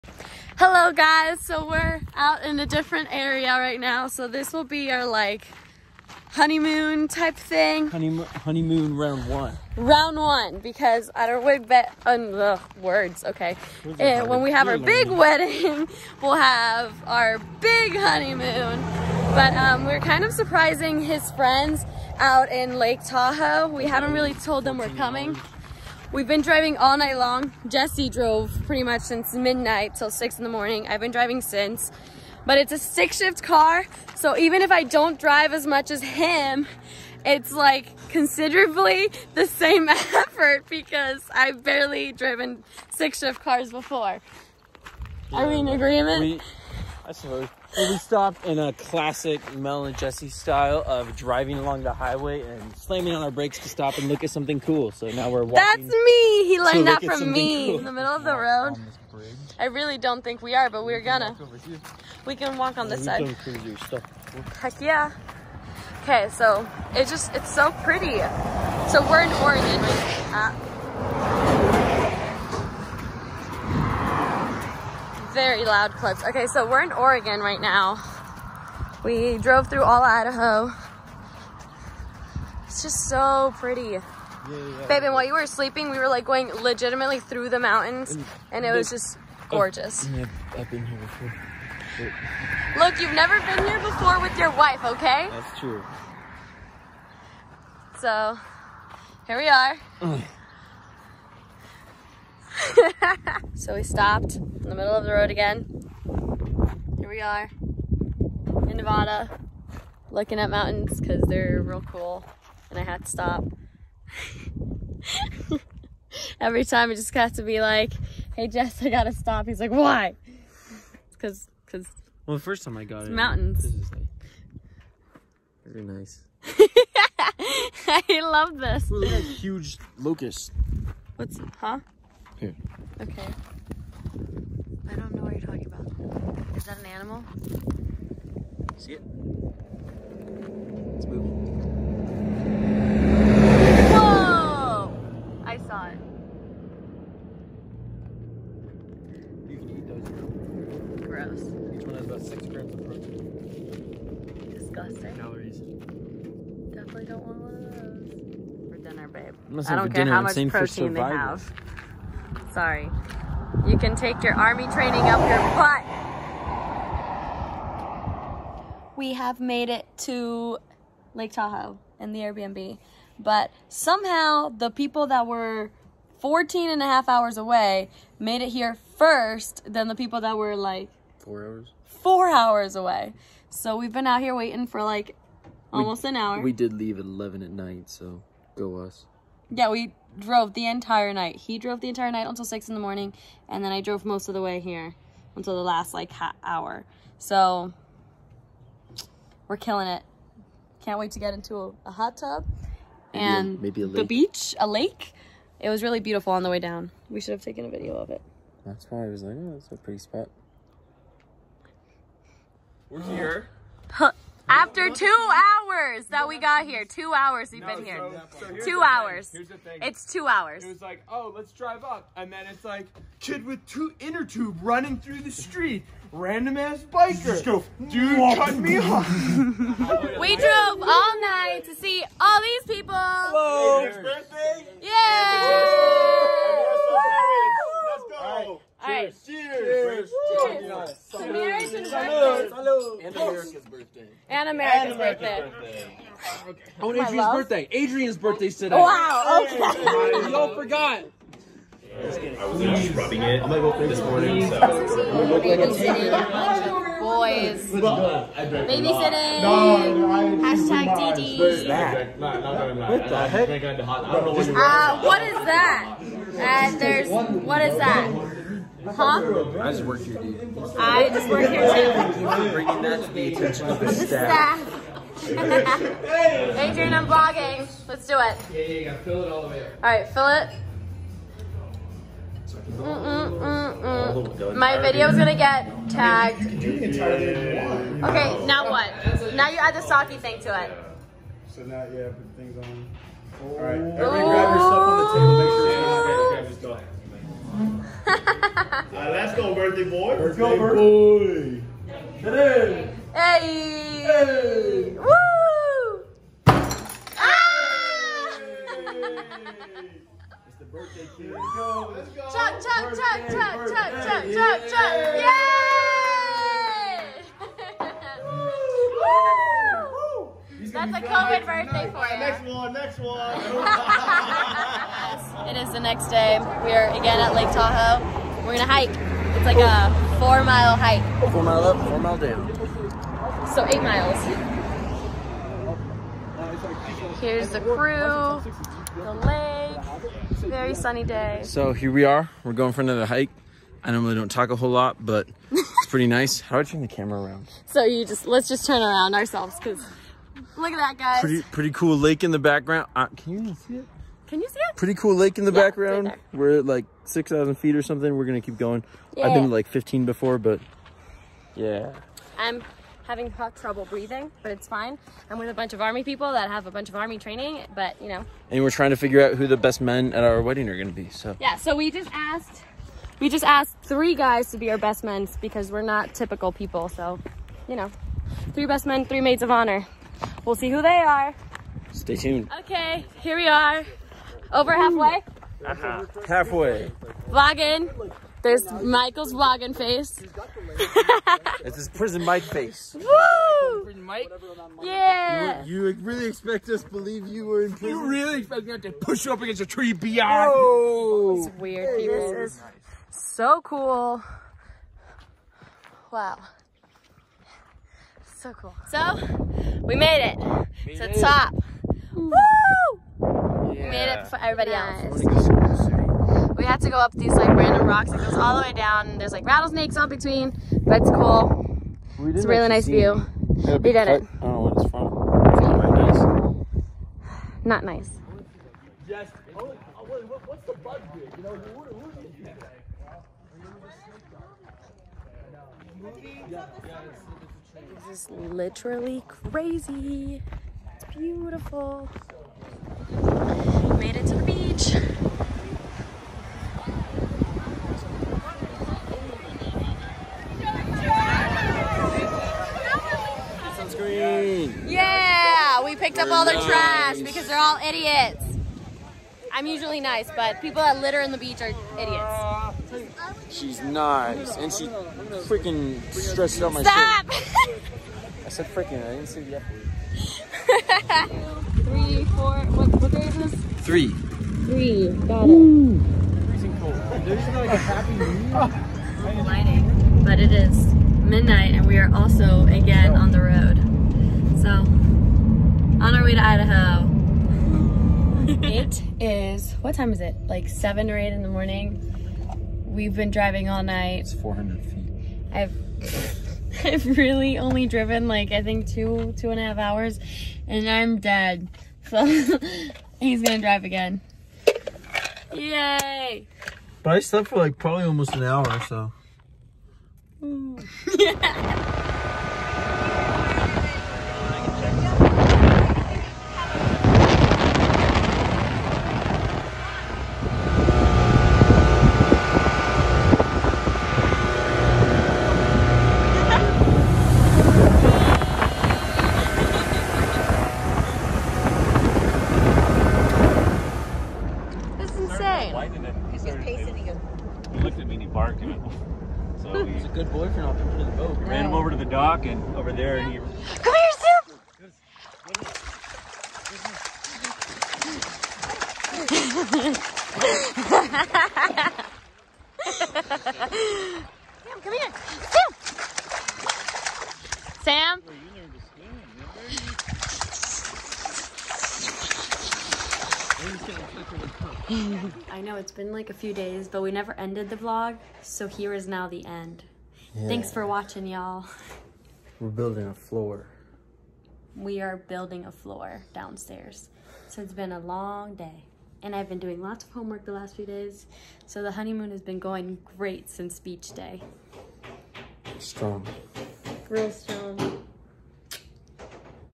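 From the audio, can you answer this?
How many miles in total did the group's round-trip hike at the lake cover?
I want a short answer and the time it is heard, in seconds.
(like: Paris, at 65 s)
8, at 333 s.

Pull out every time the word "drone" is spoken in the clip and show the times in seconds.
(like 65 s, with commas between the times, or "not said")
not said.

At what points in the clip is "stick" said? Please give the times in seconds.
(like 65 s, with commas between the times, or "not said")
32 s, 42 s.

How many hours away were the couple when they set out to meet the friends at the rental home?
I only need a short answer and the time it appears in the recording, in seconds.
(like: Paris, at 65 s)
14 and a half, at 176 s.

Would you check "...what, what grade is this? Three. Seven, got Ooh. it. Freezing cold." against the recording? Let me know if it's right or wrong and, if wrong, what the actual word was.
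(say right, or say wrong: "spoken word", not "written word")
wrong: "Three", not "Seven".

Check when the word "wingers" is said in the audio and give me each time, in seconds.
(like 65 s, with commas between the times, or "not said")
not said.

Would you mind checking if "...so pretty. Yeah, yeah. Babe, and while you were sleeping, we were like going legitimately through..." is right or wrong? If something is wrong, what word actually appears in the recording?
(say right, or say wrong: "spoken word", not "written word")
right.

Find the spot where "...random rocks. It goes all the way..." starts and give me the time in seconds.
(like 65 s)
417 s.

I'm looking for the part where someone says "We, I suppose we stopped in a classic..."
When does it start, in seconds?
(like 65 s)
46 s.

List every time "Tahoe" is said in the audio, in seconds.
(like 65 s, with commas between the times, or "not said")
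23 s, 171 s, 327 s.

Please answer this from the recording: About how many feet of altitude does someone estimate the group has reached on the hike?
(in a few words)
6,000 feet.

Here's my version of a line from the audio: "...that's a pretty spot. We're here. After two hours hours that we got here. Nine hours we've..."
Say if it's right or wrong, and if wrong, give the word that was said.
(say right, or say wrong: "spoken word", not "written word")
wrong: "Two", not "Nine".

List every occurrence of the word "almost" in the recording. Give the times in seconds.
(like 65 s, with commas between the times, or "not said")
185 s, 508 s.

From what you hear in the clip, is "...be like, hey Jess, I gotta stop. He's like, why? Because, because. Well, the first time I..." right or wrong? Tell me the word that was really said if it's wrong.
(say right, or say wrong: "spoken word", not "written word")
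right.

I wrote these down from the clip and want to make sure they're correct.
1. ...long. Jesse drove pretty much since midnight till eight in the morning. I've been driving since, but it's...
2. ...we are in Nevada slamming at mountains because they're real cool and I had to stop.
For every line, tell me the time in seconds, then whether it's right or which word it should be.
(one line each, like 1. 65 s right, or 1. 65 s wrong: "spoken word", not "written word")
1. 27 s wrong: "six", not "eight"
2. 107 s wrong: "looking", not "slamming".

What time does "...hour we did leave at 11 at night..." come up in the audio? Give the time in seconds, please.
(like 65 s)
186 s.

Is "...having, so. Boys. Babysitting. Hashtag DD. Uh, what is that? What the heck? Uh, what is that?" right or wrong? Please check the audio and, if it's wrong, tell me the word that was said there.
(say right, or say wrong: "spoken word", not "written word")
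wrong: "morning", not "having".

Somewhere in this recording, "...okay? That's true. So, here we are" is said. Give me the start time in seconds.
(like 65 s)
94 s.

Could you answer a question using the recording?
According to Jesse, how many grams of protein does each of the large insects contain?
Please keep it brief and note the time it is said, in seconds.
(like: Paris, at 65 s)
6, at 152 s.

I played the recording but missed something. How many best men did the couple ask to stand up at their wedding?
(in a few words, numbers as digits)
3.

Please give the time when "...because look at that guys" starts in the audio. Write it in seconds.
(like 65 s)
349 s.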